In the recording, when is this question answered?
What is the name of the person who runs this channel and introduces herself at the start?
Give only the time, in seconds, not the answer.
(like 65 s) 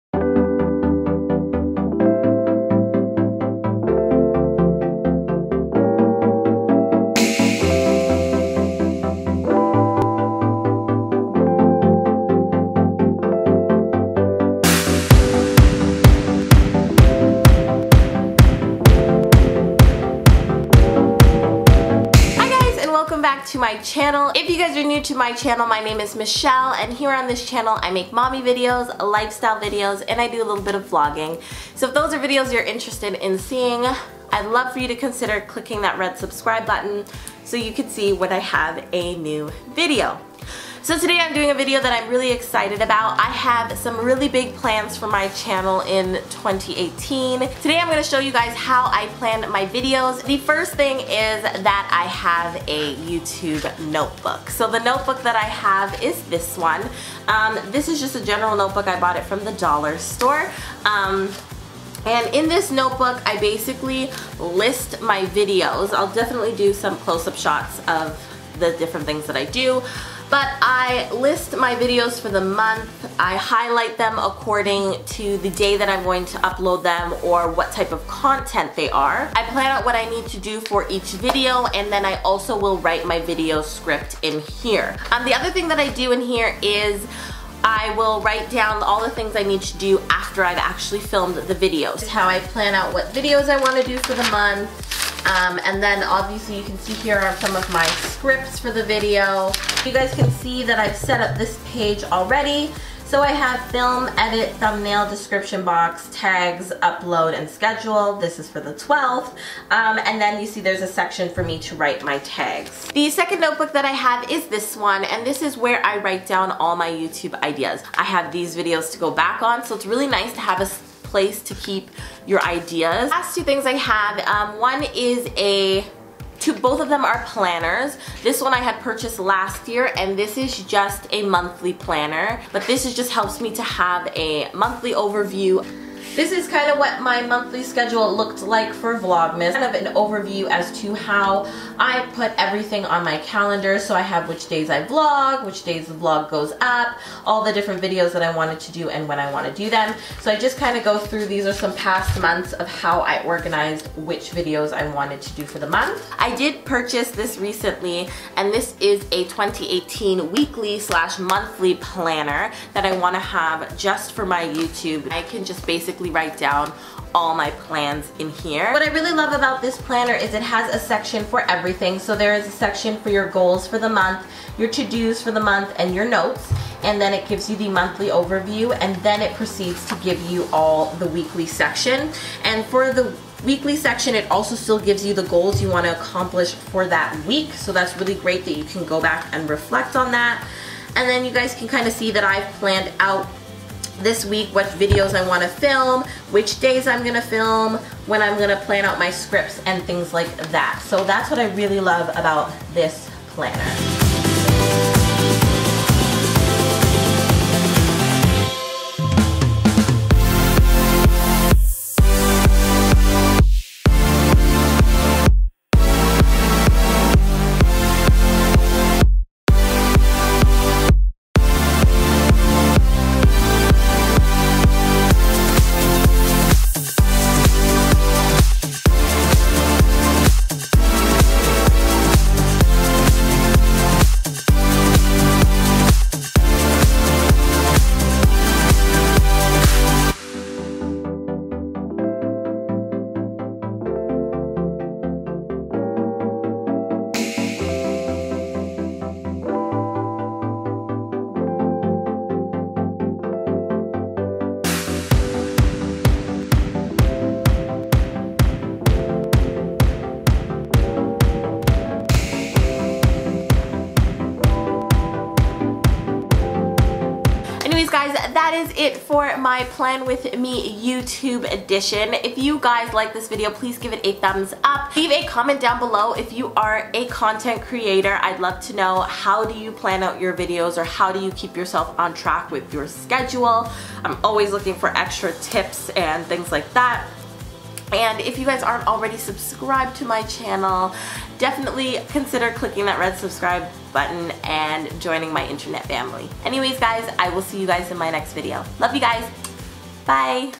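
26 s.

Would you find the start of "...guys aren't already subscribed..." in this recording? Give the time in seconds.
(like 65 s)
288 s.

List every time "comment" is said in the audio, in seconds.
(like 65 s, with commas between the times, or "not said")
275 s.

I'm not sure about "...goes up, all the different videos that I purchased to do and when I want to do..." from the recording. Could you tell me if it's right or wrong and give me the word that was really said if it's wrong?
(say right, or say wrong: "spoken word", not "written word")
wrong: "wanted", not "purchased".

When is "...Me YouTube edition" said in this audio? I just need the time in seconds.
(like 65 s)
270 s.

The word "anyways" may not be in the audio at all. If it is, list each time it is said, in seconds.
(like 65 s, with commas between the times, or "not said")
267 s, 296 s.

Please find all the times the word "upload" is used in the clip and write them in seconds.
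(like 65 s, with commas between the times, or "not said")
76 s, 106 s.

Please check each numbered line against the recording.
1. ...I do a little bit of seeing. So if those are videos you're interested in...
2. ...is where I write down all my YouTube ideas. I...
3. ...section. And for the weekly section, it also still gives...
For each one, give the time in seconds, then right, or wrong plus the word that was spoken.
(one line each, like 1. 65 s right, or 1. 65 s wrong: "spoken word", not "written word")
1. 30 s wrong: "vlogging", not "seeing"
2. 115 s right
3. 181 s right.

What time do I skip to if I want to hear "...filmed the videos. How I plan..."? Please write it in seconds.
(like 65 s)
91 s.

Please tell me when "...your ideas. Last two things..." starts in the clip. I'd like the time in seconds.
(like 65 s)
122 s.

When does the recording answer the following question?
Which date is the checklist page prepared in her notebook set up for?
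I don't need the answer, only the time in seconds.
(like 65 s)
108 s.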